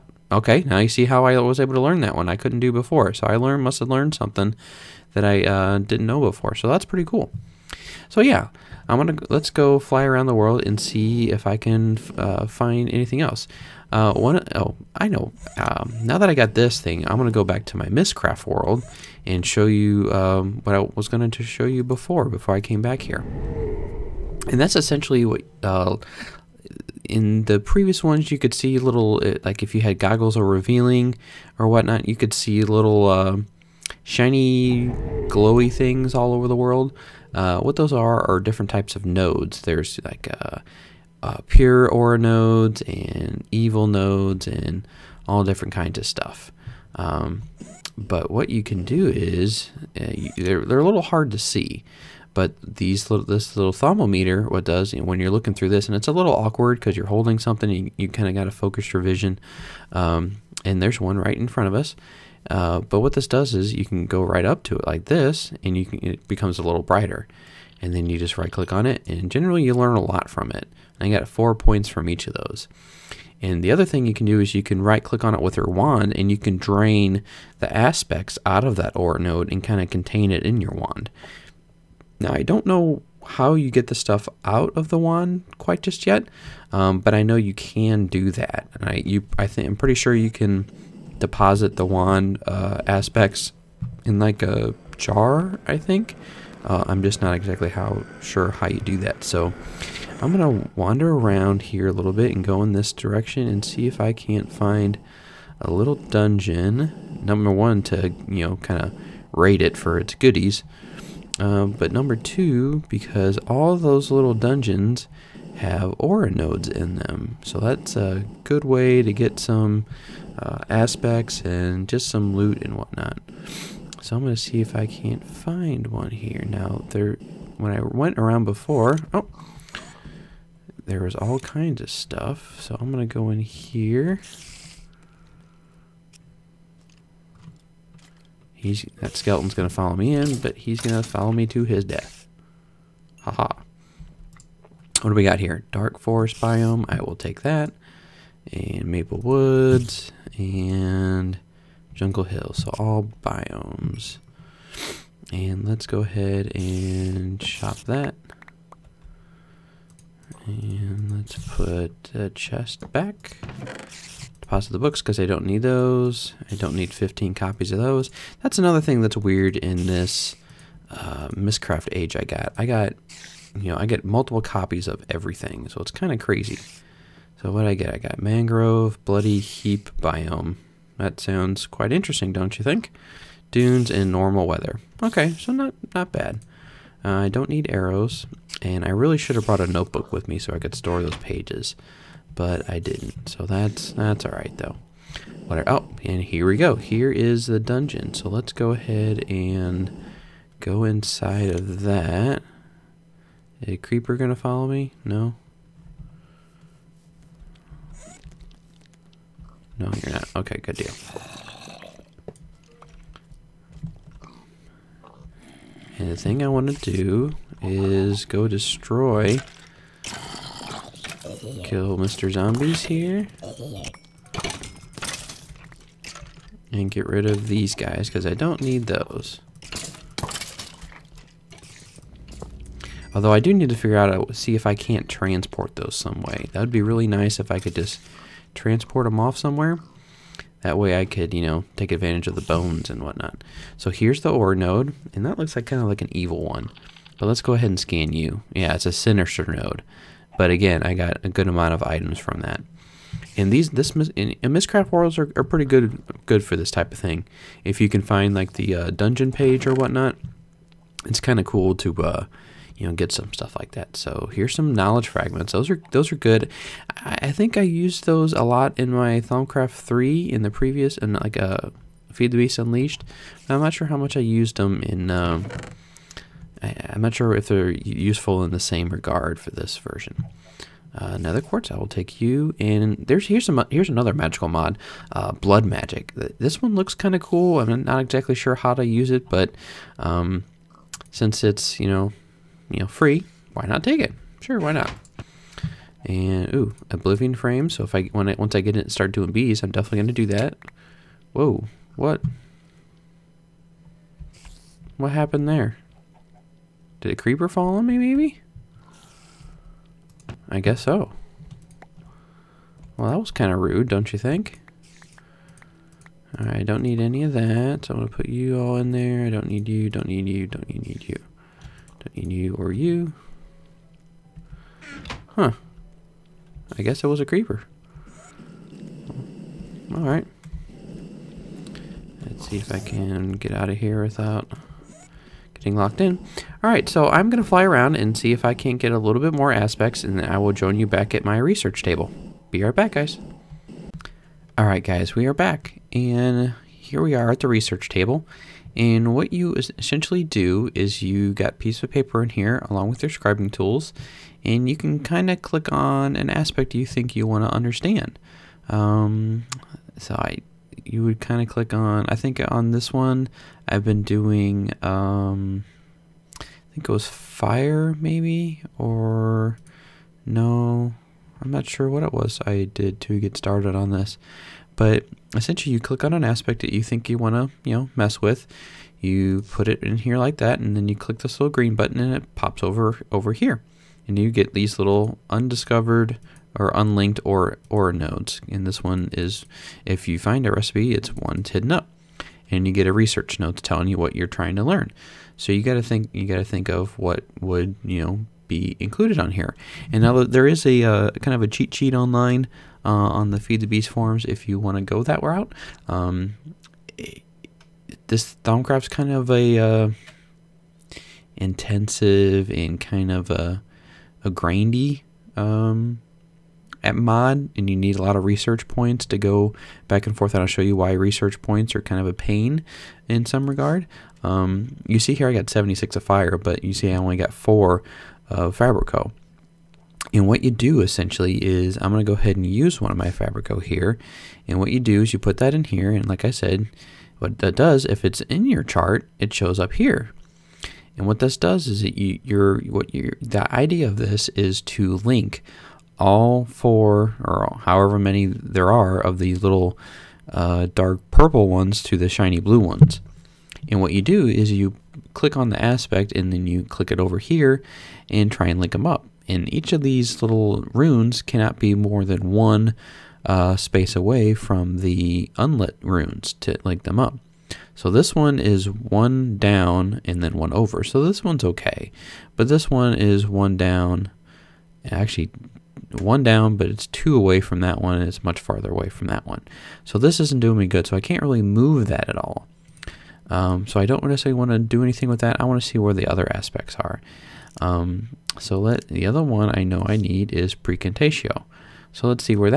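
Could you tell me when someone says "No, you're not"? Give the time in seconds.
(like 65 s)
209 s.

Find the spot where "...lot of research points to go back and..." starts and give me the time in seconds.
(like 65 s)
418 s.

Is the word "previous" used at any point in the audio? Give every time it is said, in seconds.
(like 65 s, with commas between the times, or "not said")
27 s, 270 s.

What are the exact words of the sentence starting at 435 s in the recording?
And like I said, what that does, if it's in your chart, it shows up here.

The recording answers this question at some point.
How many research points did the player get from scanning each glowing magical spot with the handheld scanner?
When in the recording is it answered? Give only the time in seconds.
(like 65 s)
71 s.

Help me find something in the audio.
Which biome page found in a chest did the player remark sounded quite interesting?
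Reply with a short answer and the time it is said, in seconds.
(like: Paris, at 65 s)
bloody heap, at 179 s.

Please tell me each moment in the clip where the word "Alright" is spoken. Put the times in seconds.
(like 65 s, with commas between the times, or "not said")
329 s, 336 s, 344 s.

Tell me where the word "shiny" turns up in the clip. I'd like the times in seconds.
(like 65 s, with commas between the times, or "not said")
34 s, 452 s.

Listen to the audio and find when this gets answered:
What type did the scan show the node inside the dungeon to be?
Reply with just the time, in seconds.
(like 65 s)
248 s.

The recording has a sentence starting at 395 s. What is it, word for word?
So you got to think you got to think of what would you know be included on here.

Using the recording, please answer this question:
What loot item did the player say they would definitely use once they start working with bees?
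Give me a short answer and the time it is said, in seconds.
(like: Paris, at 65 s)
Oblivion Frame, at 296 s.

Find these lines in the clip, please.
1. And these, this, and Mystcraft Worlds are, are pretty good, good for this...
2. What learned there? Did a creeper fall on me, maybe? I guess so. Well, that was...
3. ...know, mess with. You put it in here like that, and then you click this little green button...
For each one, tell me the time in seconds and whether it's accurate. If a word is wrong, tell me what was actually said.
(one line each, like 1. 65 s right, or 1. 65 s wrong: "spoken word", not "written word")
1. 253 s right
2. 304 s wrong: "happened", not "learned"
3. 377 s right.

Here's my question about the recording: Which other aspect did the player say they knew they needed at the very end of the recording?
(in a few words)
praecantatio.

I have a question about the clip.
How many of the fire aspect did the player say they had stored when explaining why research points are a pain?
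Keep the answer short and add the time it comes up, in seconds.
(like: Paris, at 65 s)
76, at 425 s.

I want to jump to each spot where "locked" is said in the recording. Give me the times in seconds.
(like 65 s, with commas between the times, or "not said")
335 s.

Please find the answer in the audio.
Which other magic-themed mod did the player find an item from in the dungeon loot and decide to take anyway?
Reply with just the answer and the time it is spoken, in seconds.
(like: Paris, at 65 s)
Blood Magic, at 285 s.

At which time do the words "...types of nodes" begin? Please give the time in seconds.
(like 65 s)
38 s.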